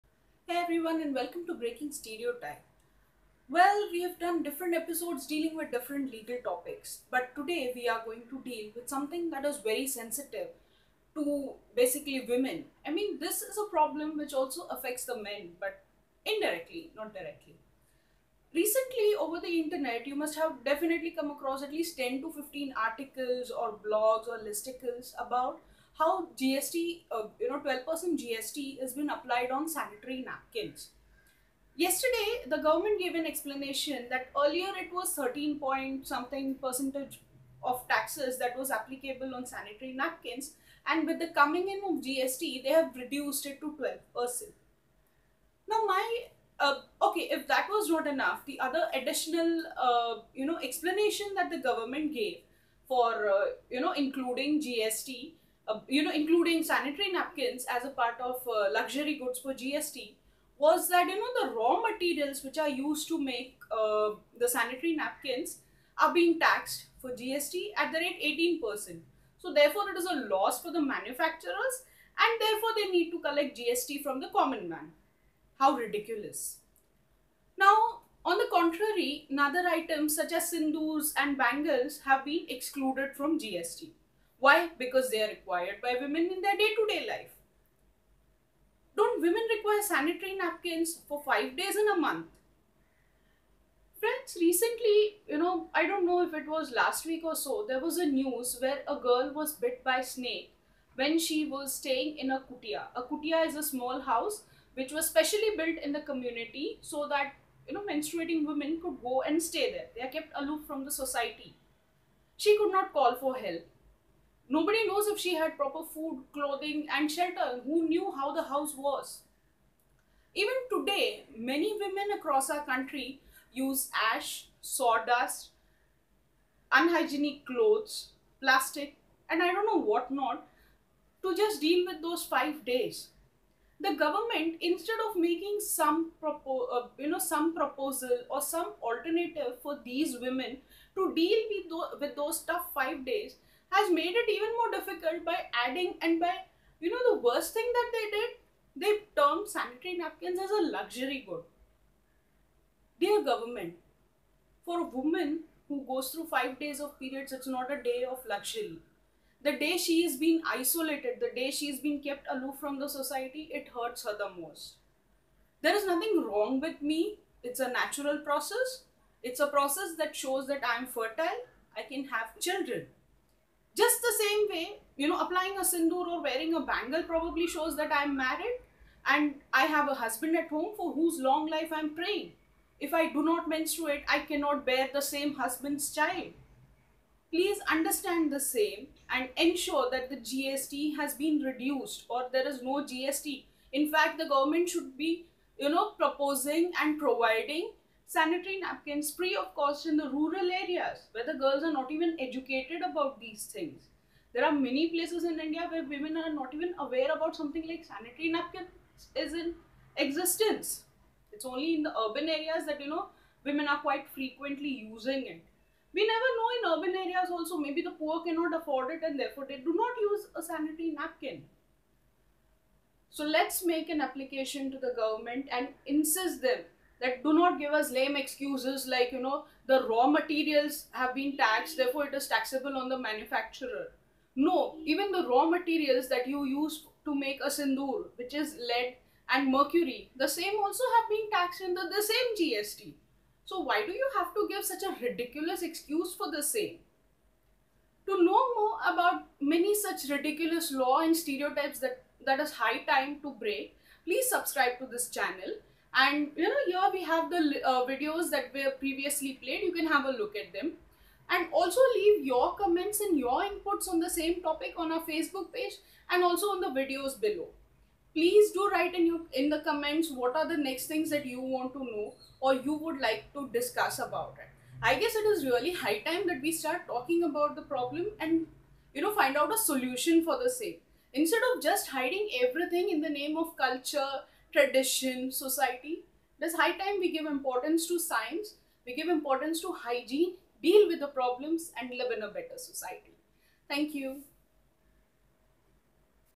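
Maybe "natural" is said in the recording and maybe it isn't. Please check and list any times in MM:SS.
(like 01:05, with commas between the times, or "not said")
02:47.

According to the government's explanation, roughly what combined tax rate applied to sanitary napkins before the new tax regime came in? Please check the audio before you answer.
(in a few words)
13 point something percent.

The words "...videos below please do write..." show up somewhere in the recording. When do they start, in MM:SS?
04:26.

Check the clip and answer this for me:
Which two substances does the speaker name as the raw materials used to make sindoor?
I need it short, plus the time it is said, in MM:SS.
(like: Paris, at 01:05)
Lead and mercury, at 03:58.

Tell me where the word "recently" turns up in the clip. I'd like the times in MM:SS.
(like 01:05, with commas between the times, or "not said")
00:18, 01:34.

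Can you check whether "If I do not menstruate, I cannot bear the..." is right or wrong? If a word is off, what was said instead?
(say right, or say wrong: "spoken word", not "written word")
right.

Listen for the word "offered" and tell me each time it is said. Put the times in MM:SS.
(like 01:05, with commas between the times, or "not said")
not said.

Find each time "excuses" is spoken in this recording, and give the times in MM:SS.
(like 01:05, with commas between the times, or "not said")
03:48, 04:05.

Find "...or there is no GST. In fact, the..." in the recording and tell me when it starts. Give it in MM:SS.
03:12.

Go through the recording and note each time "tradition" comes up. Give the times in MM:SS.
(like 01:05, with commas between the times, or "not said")
04:44.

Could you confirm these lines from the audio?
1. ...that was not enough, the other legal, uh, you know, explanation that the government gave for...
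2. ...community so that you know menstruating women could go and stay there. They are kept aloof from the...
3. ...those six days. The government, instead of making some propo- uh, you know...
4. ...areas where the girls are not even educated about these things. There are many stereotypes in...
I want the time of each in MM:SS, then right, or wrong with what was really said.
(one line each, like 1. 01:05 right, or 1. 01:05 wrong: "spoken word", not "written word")
1. 00:47 wrong: "additional", not "legal"
2. 01:46 right
3. 02:12 wrong: "five", not "six"
4. 03:20 wrong: "places", not "stereotypes".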